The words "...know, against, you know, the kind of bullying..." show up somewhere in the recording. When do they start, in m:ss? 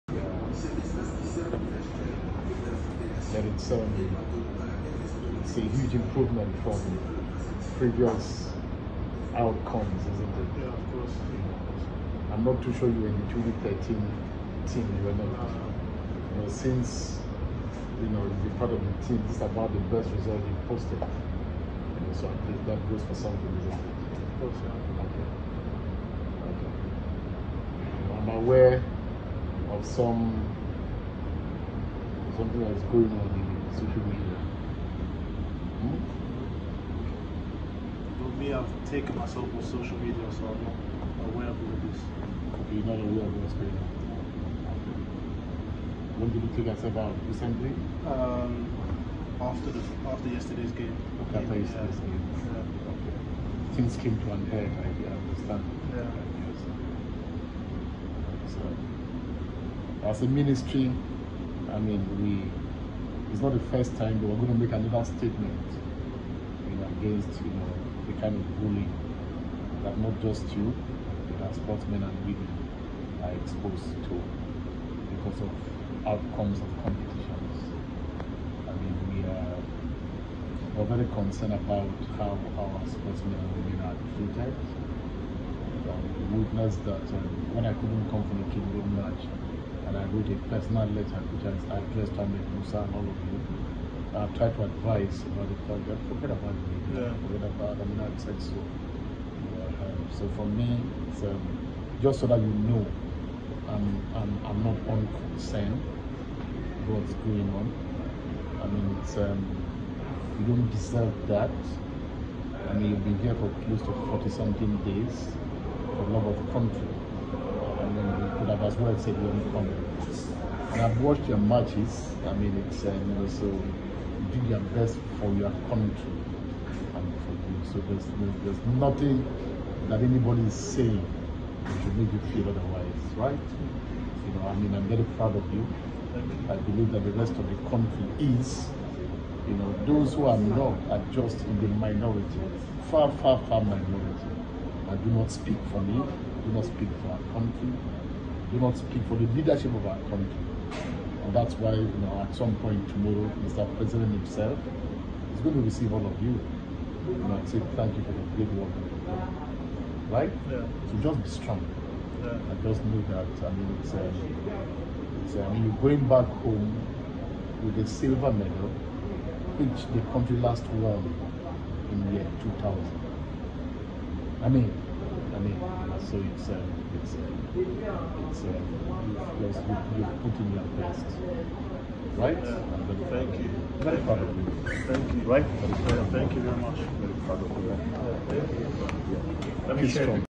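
1:06.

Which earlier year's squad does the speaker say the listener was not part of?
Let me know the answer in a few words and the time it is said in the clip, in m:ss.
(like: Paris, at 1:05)
2013, at 0:13.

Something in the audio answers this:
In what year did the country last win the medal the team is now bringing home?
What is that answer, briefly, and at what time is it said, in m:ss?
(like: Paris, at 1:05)
2000, at 2:52.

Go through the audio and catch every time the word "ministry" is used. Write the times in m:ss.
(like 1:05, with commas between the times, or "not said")
1:00.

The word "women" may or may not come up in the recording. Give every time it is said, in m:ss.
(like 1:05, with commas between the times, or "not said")
1:12, 1:23.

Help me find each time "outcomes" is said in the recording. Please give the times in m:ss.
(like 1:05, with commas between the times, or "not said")
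0:09, 1:16.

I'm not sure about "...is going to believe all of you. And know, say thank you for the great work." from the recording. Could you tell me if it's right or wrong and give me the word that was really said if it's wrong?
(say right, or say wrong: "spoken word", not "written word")
wrong: "receive", not "believe".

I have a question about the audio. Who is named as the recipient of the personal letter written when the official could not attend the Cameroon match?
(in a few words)
Ahmed Musa.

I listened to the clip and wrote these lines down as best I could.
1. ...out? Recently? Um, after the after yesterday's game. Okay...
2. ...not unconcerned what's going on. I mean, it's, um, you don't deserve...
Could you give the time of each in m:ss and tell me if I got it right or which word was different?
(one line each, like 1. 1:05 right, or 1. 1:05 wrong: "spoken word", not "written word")
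1. 0:46 right
2. 1:44 right.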